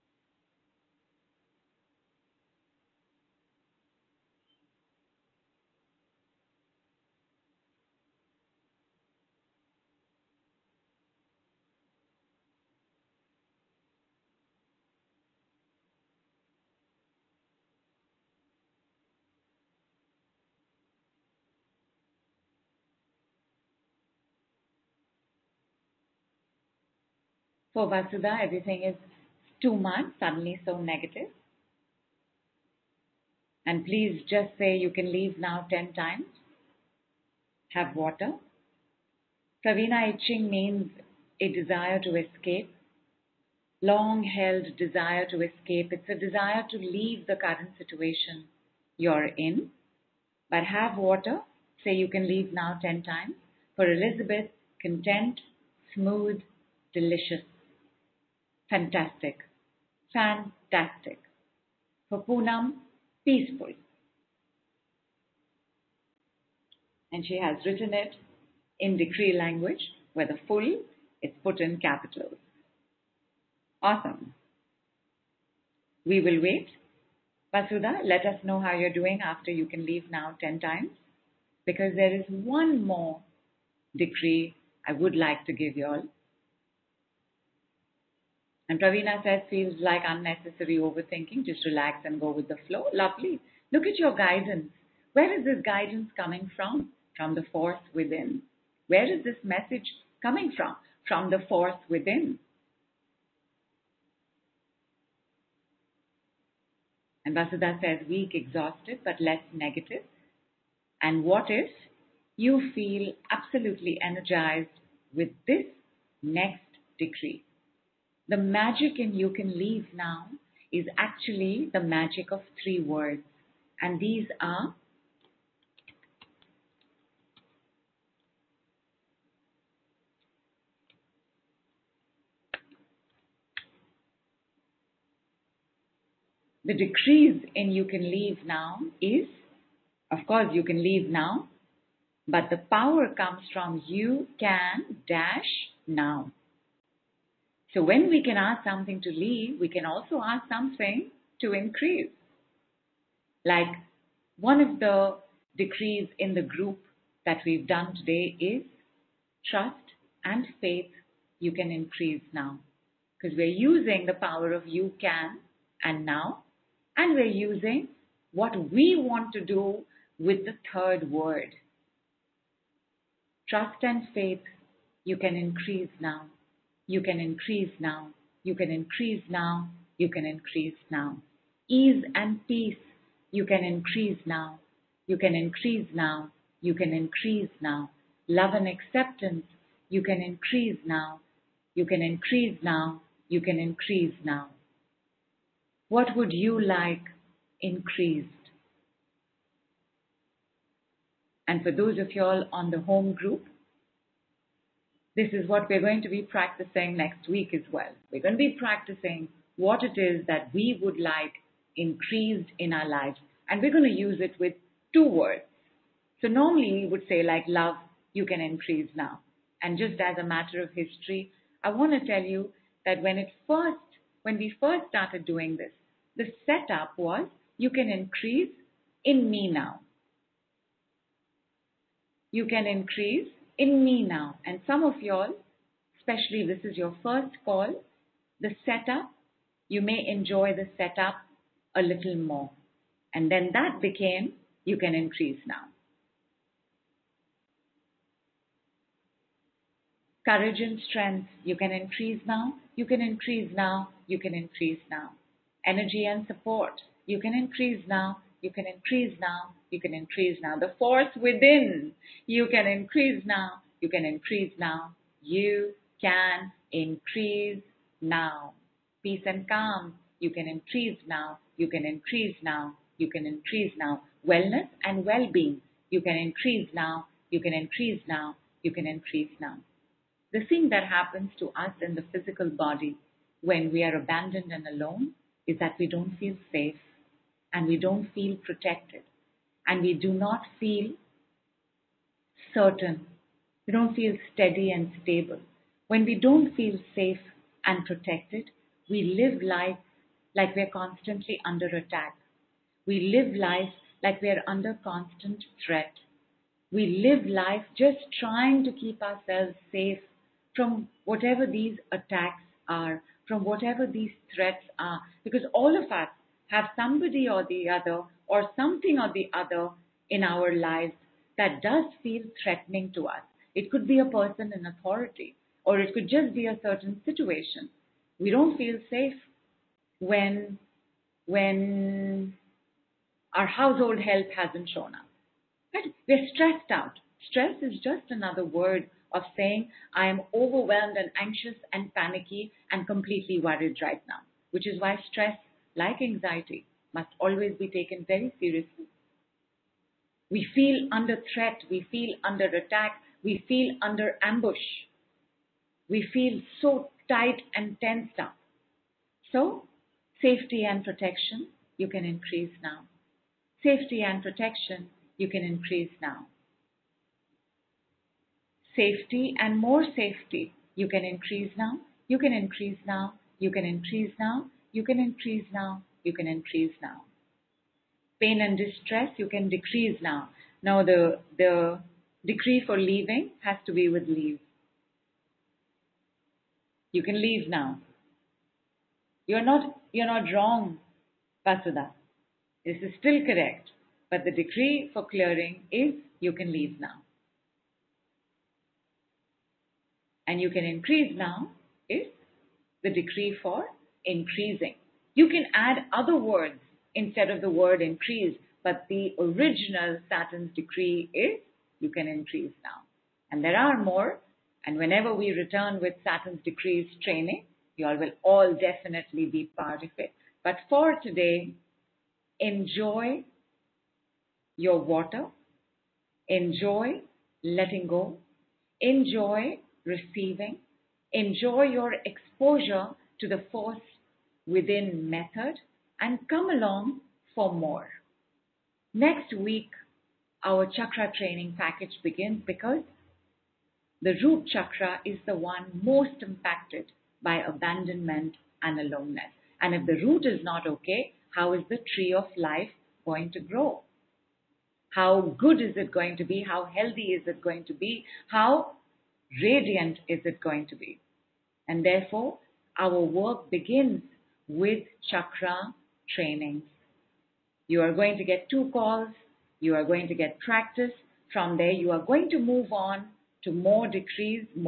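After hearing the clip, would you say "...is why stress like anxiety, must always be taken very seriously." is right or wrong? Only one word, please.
right.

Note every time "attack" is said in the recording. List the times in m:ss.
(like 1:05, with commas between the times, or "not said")
5:01, 5:11, 5:52.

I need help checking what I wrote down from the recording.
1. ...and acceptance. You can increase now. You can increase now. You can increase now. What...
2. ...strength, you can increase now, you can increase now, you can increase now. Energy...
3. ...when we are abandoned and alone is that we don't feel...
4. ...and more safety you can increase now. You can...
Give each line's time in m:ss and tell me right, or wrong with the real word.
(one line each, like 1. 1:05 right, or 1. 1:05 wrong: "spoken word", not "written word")
1. 3:08 right
2. 4:10 right
3. 4:43 right
4. 6:09 right.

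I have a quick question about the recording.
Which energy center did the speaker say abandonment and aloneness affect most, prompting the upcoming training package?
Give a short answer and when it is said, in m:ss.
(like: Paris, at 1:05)
root chakra, at 7:24.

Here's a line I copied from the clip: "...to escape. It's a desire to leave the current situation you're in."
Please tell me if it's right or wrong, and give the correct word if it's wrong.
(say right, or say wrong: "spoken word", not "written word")
right.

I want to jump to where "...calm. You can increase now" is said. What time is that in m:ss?
4:29.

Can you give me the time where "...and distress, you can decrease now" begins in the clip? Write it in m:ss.
6:18.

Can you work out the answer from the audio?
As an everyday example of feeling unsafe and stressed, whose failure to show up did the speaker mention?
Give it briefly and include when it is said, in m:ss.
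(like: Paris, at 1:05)
household help, at 5:33.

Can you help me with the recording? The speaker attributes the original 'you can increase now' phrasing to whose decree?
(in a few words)
Saturn's decree.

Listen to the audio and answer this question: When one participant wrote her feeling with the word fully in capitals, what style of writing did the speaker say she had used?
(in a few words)
decree language.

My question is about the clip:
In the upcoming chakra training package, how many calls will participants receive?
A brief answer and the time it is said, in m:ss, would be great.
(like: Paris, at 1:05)
2, at 7:48.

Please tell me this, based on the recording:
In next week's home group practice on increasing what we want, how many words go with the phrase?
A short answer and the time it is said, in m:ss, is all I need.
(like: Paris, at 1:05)
2, at 3:34.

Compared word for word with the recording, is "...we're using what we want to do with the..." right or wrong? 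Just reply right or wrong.
right.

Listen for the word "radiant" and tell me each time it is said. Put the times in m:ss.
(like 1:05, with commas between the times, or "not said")
7:39.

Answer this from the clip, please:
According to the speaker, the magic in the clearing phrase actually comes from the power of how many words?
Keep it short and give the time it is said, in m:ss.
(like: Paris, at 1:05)
3, at 2:02.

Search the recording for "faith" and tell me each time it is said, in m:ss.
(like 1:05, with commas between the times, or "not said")
2:40, 2:54.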